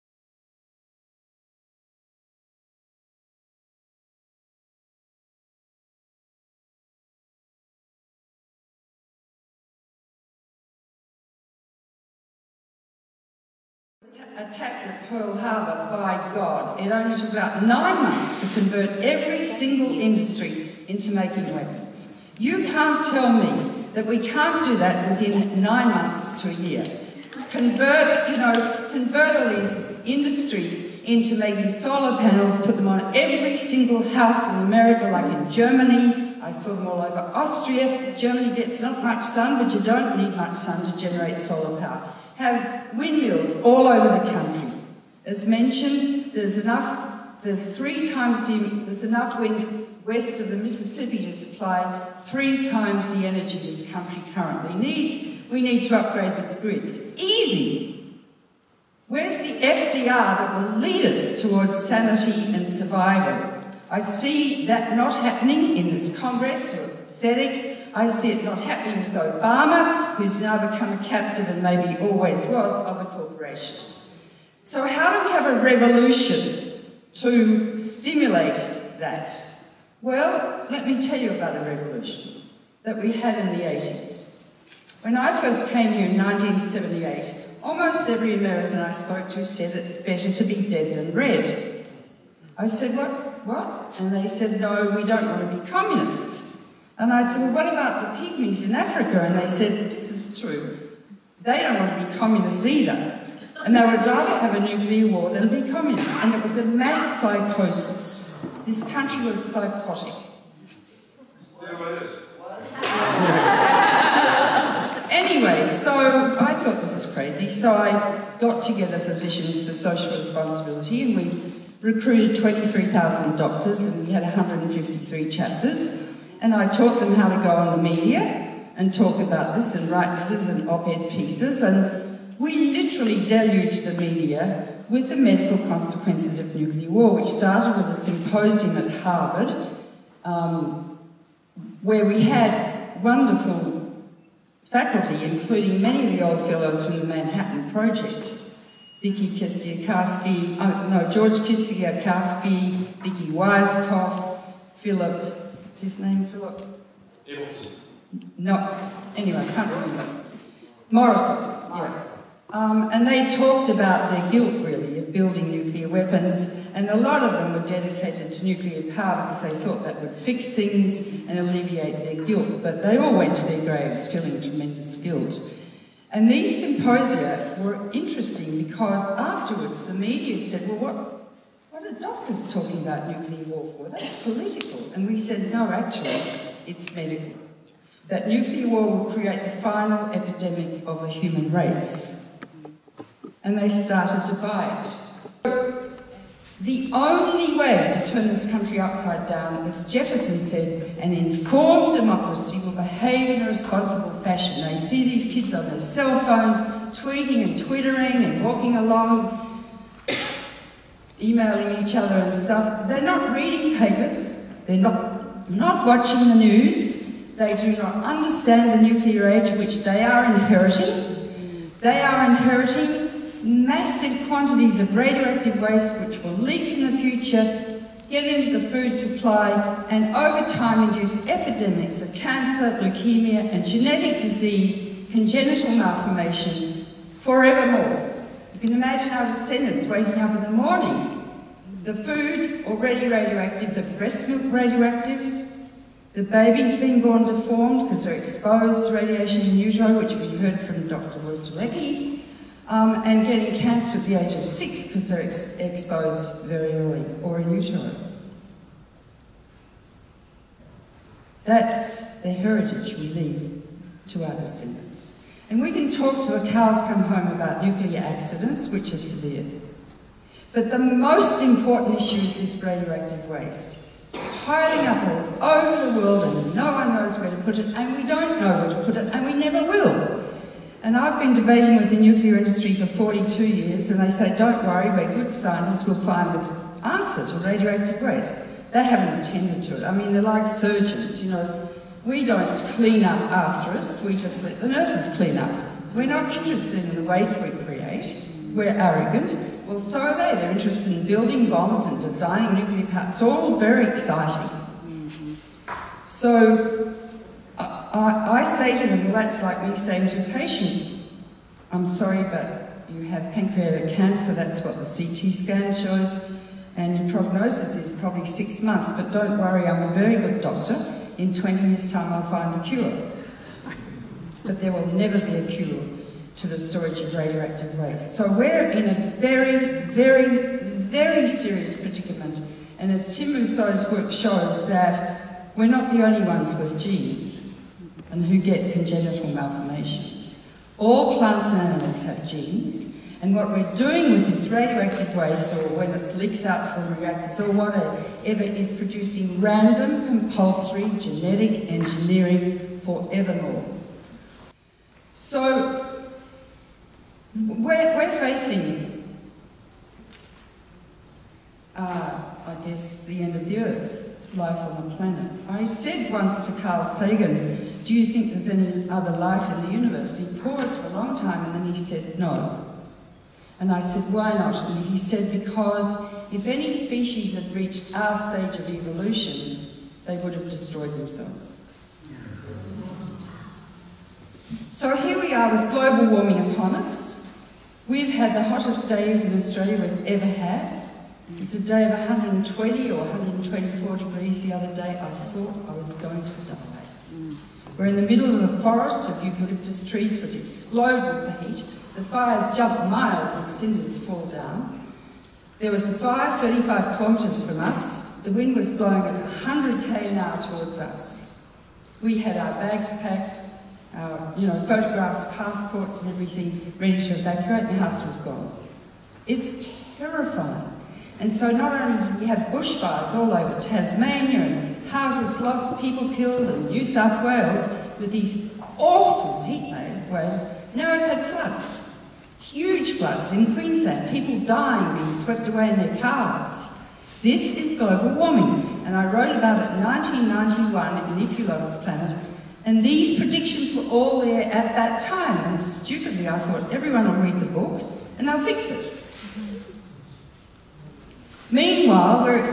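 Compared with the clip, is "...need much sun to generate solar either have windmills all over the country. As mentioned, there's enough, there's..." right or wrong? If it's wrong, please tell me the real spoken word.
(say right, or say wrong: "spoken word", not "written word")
wrong: "power", not "either".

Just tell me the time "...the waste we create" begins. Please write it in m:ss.
4:56.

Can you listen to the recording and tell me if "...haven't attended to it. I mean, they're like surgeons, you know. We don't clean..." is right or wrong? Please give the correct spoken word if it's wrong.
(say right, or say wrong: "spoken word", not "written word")
right.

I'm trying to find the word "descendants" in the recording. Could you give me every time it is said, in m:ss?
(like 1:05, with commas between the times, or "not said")
3:59, 4:24.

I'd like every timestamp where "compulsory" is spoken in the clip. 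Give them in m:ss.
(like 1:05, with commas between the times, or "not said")
5:50.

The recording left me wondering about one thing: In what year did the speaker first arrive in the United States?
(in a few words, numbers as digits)
1978.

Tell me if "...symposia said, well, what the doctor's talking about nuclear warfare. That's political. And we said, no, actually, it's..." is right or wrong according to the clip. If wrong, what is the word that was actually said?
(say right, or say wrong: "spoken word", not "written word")
wrong: "media", not "symposia".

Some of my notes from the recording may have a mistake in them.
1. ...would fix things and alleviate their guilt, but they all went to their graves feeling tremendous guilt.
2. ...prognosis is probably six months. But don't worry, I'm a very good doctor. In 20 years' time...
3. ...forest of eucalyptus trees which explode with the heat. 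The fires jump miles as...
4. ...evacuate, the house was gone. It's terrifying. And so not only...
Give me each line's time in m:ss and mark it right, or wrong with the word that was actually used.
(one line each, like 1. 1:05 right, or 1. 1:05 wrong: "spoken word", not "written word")
1. 2:50 right
2. 5:17 right
3. 6:38 right
4. 6:57 right.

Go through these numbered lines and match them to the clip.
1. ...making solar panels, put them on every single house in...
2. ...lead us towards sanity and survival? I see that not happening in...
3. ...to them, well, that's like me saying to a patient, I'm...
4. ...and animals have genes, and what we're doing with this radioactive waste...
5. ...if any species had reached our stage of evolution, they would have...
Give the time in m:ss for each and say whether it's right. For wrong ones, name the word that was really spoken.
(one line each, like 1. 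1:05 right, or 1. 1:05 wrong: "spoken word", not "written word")
1. 0:31 right
2. 1:00 right
3. 5:08 right
4. 5:41 right
5. 6:16 right.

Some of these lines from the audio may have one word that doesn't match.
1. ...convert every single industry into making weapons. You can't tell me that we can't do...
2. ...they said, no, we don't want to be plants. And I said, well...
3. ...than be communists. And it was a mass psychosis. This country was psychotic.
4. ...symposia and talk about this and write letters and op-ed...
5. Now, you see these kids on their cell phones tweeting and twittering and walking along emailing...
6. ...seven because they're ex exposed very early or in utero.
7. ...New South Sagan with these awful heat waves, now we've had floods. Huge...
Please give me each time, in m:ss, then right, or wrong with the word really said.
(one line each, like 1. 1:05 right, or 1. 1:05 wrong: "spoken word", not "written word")
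1. 0:18 right
2. 1:34 wrong: "communists", not "plants"
3. 1:45 right
4. 2:07 wrong: "media", not "symposia"
5. 3:24 right
6. 4:14 wrong: "six", not "seven"
7. 7:06 wrong: "Wales", not "Sagan".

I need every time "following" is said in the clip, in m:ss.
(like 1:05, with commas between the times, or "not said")
not said.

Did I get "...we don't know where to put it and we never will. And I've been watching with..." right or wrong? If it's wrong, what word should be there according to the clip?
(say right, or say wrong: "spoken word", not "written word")
wrong: "debating", not "watching".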